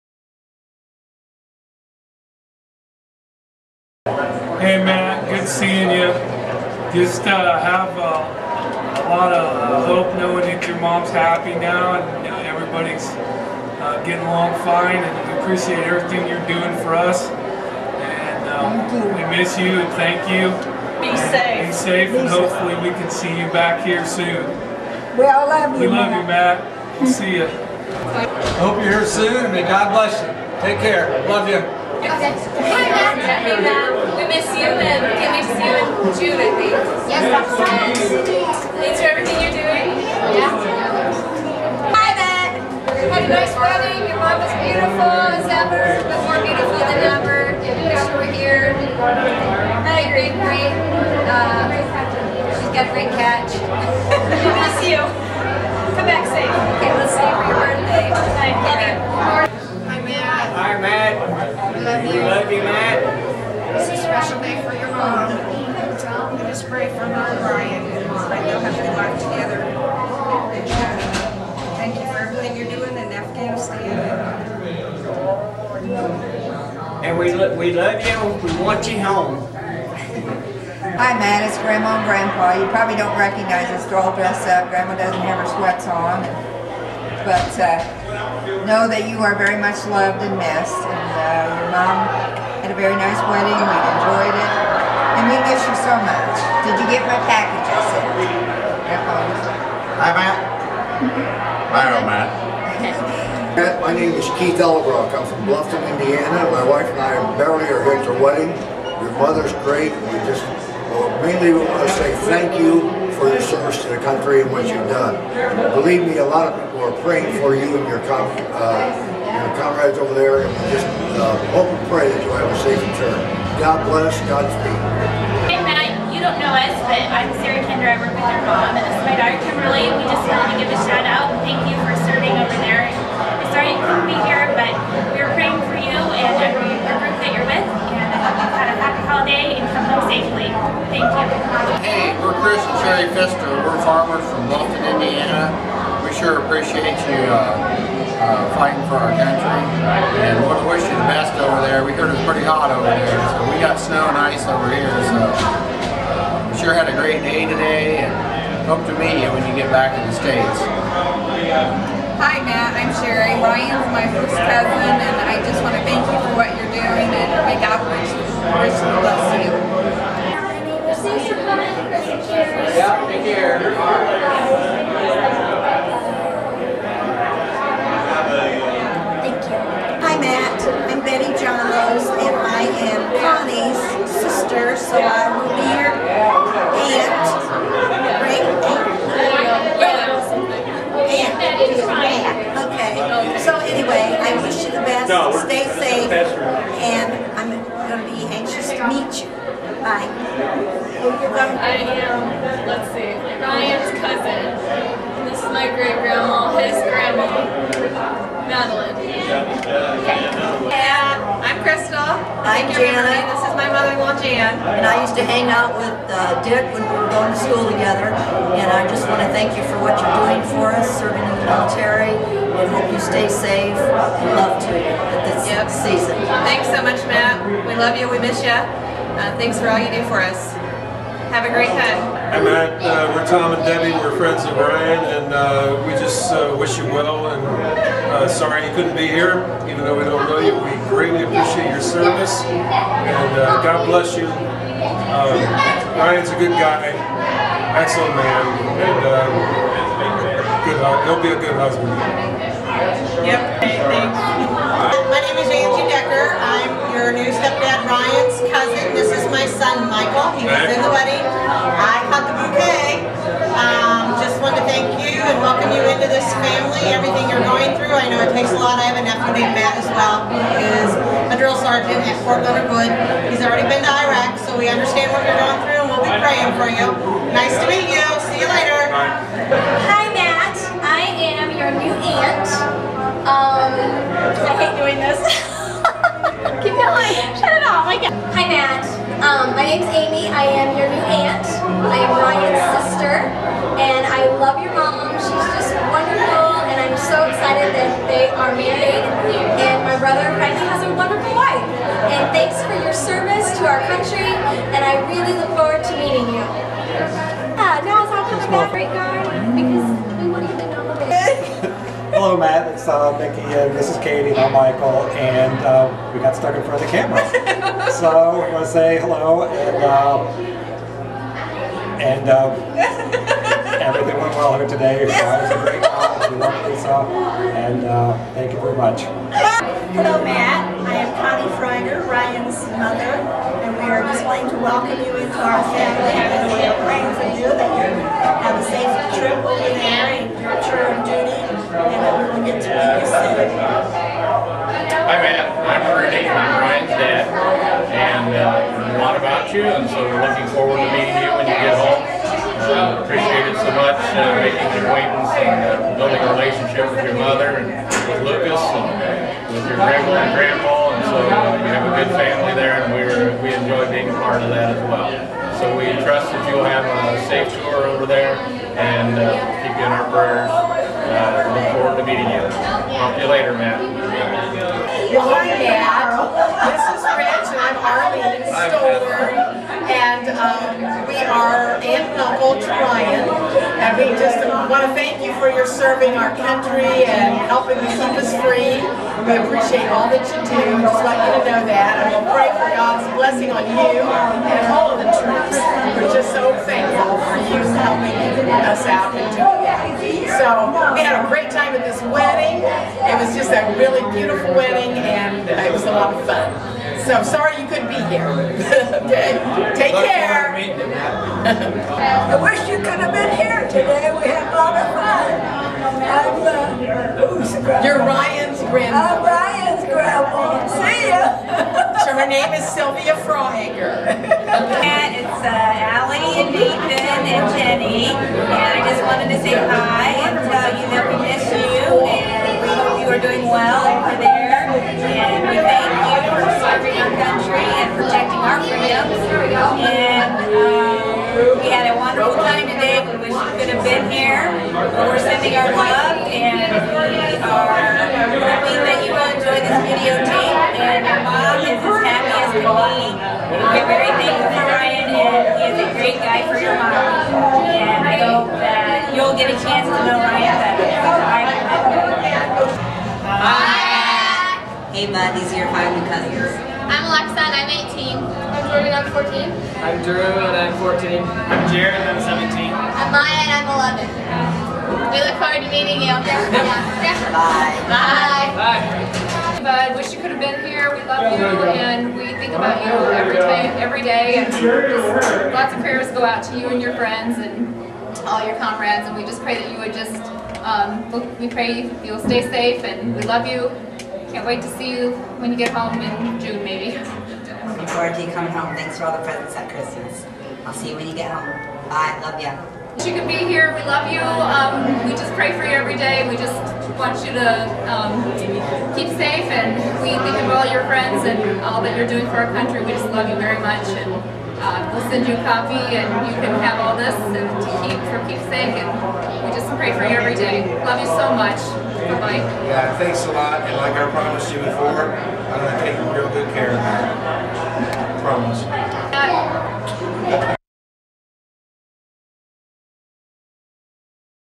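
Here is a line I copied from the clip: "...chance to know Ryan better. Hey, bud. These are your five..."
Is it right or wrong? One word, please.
right.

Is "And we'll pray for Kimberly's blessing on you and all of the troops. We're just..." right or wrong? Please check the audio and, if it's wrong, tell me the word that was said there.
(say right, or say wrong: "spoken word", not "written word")
wrong: "God", not "Kimberly".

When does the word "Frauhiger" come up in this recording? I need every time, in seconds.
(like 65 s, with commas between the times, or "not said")
331 s, 423 s.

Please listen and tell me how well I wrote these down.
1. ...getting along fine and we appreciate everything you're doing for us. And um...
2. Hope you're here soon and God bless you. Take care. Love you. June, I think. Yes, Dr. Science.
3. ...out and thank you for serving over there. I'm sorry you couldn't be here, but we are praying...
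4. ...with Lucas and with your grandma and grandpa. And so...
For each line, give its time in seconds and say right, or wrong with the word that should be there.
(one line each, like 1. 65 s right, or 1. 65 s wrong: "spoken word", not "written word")
1. 14 s right
2. 28 s right
3. 131 s right
4. 358 s right.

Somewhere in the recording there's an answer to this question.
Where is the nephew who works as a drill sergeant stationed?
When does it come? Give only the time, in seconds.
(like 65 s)
272 s.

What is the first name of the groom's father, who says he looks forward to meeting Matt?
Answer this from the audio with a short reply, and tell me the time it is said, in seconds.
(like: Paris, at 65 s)
Rudy, at 345 s.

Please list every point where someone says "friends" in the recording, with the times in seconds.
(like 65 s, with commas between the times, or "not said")
234 s, 486 s, 510 s.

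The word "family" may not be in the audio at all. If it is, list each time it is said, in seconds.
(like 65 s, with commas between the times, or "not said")
266 s, 335 s, 362 s.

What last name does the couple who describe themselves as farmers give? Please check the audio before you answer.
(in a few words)
Fister.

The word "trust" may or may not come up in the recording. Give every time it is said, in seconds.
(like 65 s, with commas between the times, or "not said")
366 s.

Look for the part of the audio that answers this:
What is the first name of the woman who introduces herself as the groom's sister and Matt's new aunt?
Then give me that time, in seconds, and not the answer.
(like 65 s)
289 s.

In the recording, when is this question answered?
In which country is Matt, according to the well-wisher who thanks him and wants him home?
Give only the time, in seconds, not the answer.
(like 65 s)
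73 s.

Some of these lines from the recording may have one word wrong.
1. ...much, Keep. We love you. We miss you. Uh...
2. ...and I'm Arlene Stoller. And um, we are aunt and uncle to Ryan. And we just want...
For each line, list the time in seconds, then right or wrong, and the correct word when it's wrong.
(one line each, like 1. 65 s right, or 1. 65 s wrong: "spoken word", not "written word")
1. 226 s wrong: "Matt", not "Keep"
2. 377 s right.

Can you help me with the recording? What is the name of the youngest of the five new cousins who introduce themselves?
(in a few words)
Maya.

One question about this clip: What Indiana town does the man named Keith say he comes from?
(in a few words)
Bluffton, Indiana.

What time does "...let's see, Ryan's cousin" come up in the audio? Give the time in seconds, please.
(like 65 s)
202 s.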